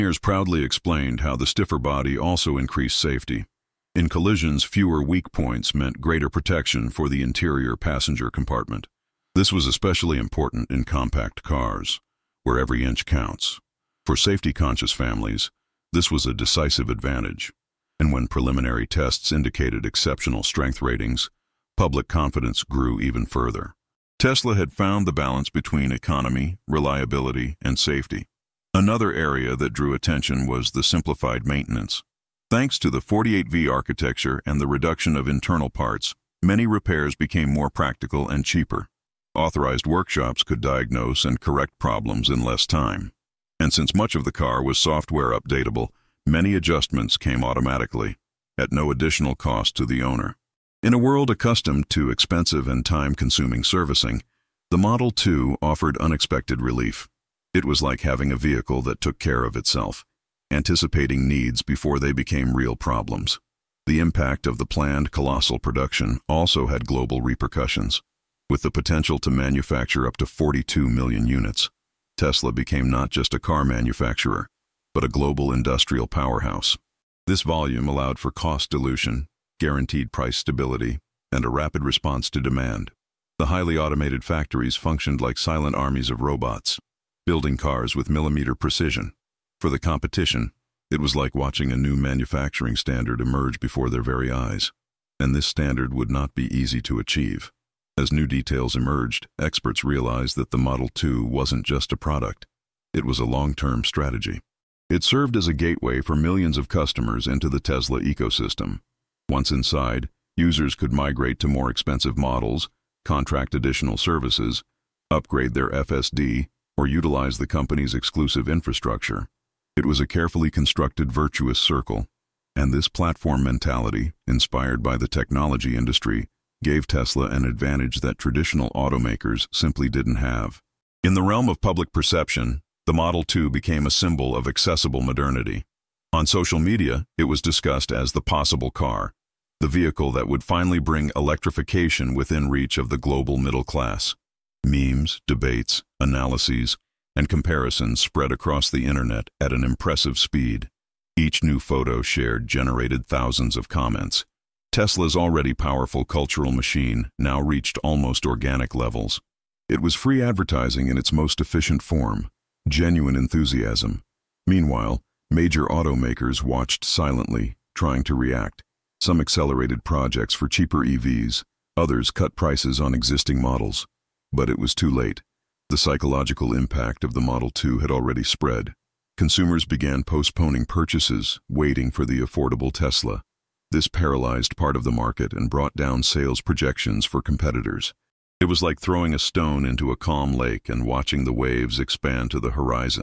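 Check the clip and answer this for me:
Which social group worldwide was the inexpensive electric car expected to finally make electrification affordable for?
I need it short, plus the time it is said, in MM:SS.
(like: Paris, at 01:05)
global middle class, at 02:22.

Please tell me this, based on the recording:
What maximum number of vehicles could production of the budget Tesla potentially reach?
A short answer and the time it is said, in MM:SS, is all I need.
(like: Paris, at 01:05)
42 million, at 01:10.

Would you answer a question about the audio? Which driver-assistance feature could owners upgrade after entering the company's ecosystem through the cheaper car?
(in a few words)
FSD.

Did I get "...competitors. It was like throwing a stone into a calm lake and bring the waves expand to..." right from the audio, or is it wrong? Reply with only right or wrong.
wrong.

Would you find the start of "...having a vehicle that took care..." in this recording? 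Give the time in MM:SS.
00:58.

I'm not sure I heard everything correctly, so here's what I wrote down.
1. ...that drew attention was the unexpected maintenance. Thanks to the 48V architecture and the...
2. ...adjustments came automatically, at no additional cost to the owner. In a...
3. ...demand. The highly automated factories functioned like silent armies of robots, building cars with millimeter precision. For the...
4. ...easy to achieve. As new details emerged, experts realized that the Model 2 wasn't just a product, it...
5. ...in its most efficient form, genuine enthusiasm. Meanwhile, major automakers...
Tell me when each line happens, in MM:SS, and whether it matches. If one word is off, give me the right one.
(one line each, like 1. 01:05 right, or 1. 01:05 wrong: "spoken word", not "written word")
1. 00:29 wrong: "simplified", not "unexpected"
2. 00:46 right
3. 01:22 right
4. 01:36 right
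5. 02:40 right.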